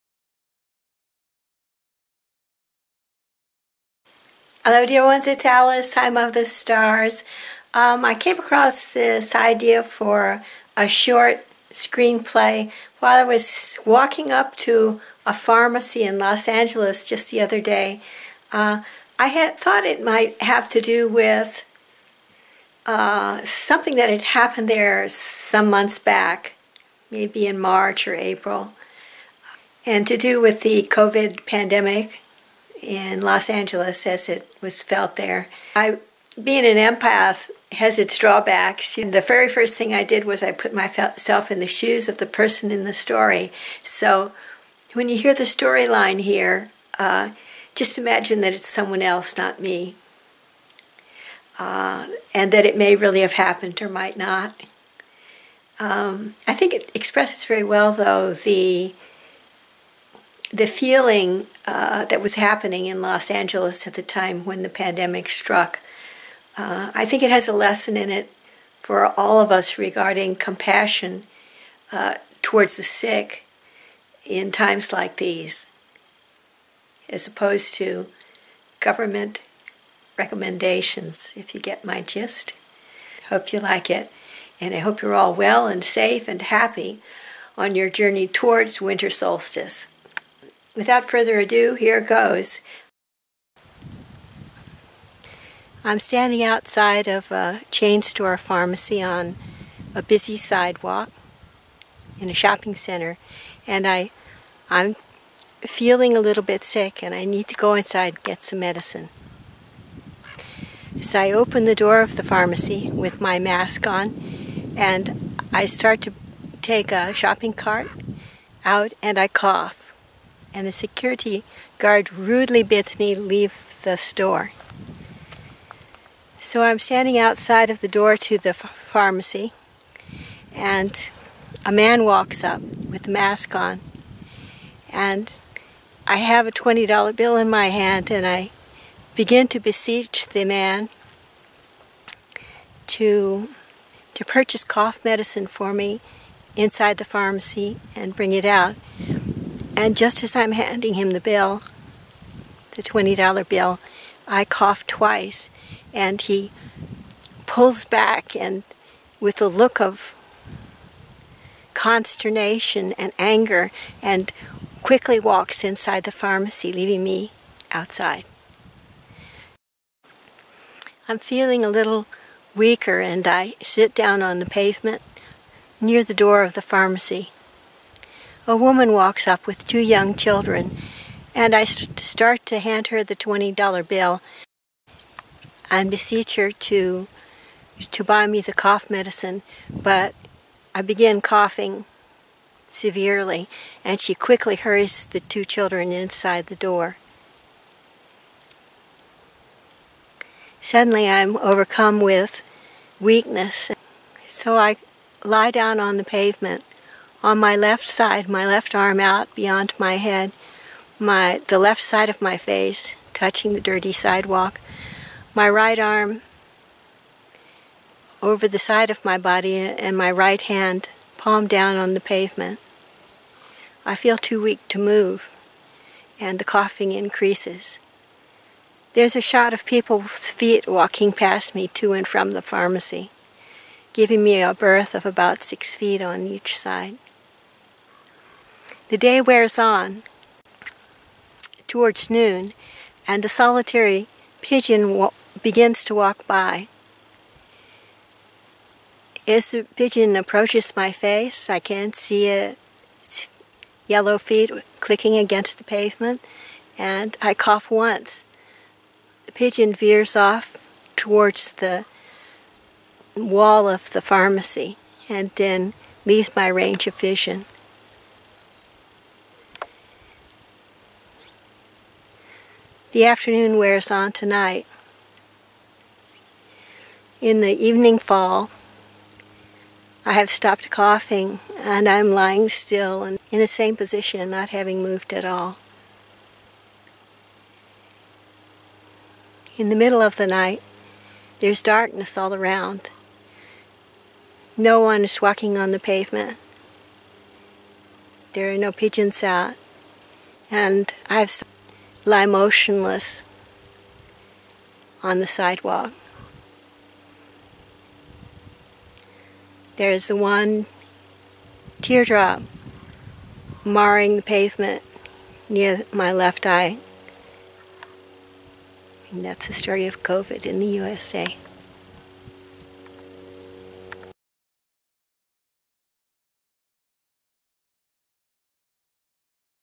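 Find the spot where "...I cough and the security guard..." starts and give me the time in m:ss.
1:59.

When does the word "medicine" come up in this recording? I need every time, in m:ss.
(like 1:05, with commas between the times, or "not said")
1:48, 2:25, 3:08.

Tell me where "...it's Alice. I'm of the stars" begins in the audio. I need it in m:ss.
0:05.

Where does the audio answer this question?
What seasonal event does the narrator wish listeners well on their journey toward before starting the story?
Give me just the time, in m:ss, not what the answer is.
1:28.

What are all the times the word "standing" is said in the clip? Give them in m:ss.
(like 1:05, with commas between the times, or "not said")
1:35, 2:06.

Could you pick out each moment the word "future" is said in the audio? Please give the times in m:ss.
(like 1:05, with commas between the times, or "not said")
not said.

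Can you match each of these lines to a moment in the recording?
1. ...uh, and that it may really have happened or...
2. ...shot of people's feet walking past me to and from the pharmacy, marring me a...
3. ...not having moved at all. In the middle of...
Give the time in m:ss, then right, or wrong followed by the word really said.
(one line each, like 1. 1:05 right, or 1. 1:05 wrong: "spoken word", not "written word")
1. 0:51 right
2. 3:49 wrong: "giving", not "marring"
3. 4:44 right.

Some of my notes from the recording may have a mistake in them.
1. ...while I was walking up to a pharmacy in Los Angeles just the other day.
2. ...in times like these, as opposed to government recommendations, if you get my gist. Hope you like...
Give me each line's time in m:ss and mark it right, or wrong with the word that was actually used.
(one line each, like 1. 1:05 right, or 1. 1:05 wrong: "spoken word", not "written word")
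1. 0:12 right
2. 1:14 right.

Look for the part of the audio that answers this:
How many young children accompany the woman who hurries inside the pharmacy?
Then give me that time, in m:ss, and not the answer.
2:59.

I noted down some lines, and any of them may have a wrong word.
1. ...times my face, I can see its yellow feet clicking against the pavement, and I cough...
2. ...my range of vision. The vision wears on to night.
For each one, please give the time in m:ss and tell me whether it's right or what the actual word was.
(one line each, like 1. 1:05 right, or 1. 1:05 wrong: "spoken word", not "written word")
1. 4:10 wrong: "approaches", not "times"
2. 4:26 wrong: "afternoon", not "vision".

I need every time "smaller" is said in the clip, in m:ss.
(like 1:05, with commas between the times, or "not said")
not said.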